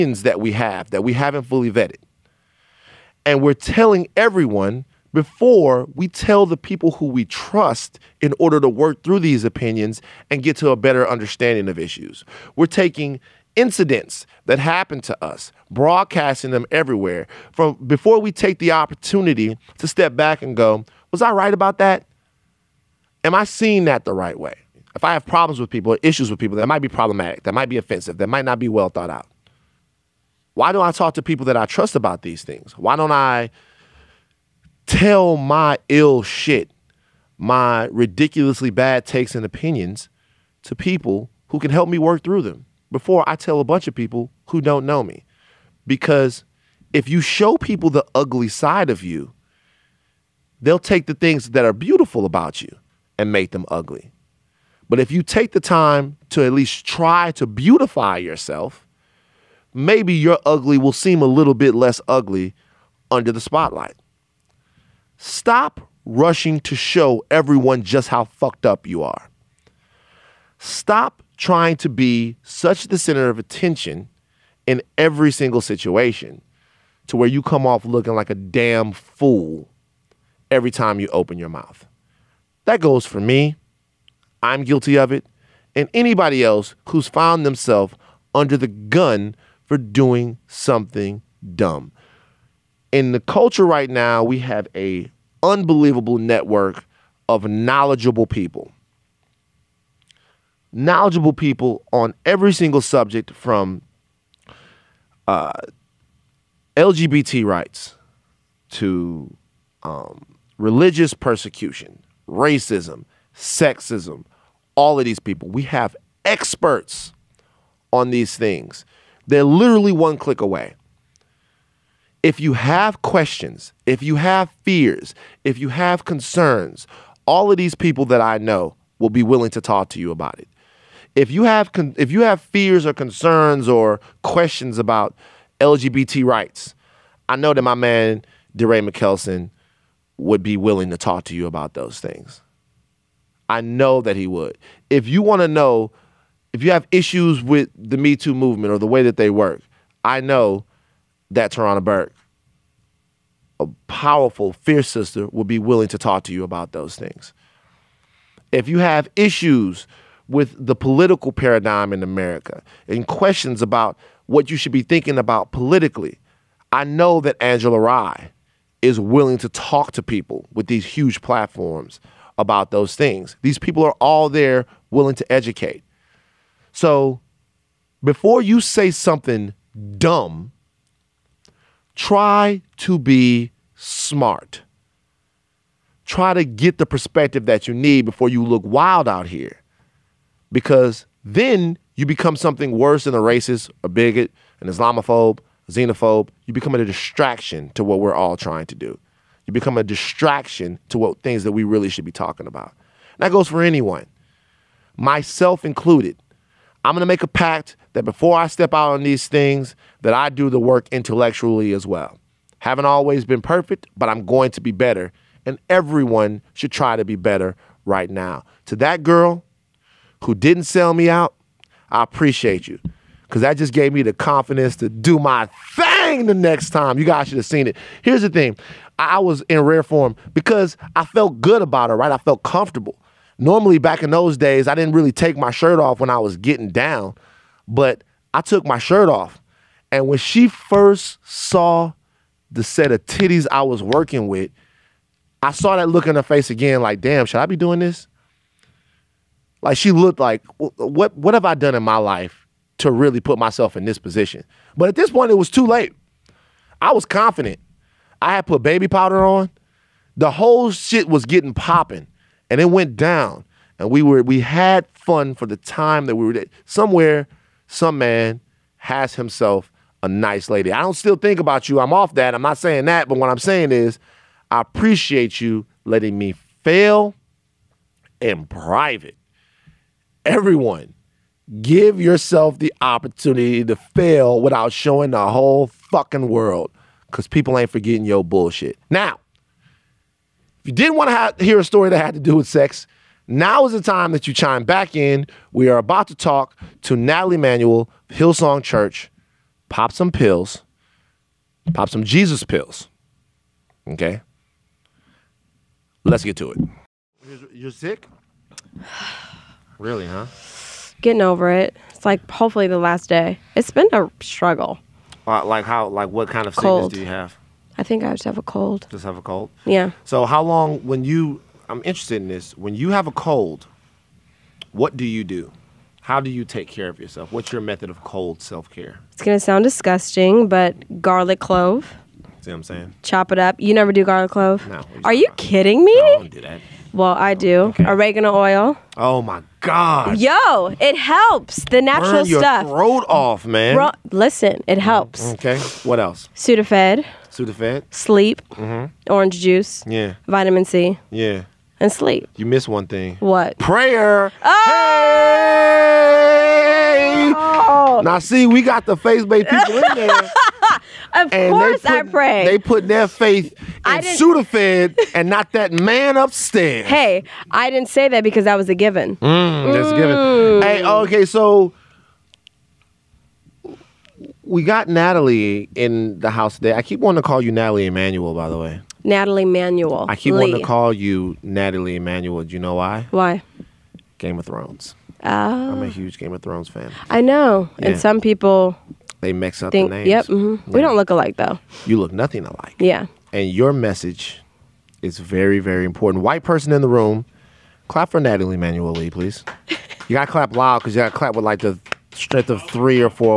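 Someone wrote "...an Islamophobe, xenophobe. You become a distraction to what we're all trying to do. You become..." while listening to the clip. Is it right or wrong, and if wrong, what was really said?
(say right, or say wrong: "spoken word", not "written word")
right.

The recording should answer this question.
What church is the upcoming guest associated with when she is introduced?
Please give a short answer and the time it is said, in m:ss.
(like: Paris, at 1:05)
Hillsong Church, at 4:58.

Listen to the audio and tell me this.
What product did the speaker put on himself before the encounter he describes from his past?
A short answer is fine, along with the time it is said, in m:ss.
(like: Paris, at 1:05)
Baby powder, at 4:18.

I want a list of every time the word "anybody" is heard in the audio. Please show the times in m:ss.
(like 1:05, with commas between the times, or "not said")
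1:25.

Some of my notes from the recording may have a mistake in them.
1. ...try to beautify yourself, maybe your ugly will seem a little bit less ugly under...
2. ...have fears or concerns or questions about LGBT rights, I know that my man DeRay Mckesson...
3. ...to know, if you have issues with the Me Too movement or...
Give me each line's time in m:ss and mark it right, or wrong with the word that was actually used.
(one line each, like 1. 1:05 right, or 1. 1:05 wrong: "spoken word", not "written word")
1. 0:56 right
2. 2:12 right
3. 2:25 right.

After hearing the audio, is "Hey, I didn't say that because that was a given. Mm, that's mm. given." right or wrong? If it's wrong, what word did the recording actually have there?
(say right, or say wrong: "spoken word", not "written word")
right.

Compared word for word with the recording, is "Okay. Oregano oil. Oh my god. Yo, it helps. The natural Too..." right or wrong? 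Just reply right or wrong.
wrong.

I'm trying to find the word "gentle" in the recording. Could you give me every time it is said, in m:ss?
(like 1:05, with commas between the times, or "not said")
not said.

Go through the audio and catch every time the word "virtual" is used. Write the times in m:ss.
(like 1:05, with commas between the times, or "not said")
not said.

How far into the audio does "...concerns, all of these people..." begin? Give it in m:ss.
2:06.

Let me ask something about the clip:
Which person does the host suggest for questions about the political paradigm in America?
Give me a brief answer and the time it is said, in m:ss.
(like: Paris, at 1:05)
Angela Rye, at 2:47.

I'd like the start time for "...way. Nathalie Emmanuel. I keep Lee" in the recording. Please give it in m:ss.
6:18.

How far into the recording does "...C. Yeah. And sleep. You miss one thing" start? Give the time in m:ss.
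5:50.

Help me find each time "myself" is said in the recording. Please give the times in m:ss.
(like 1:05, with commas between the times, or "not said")
3:24, 4:13.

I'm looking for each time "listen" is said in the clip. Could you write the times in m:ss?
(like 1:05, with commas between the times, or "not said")
5:44.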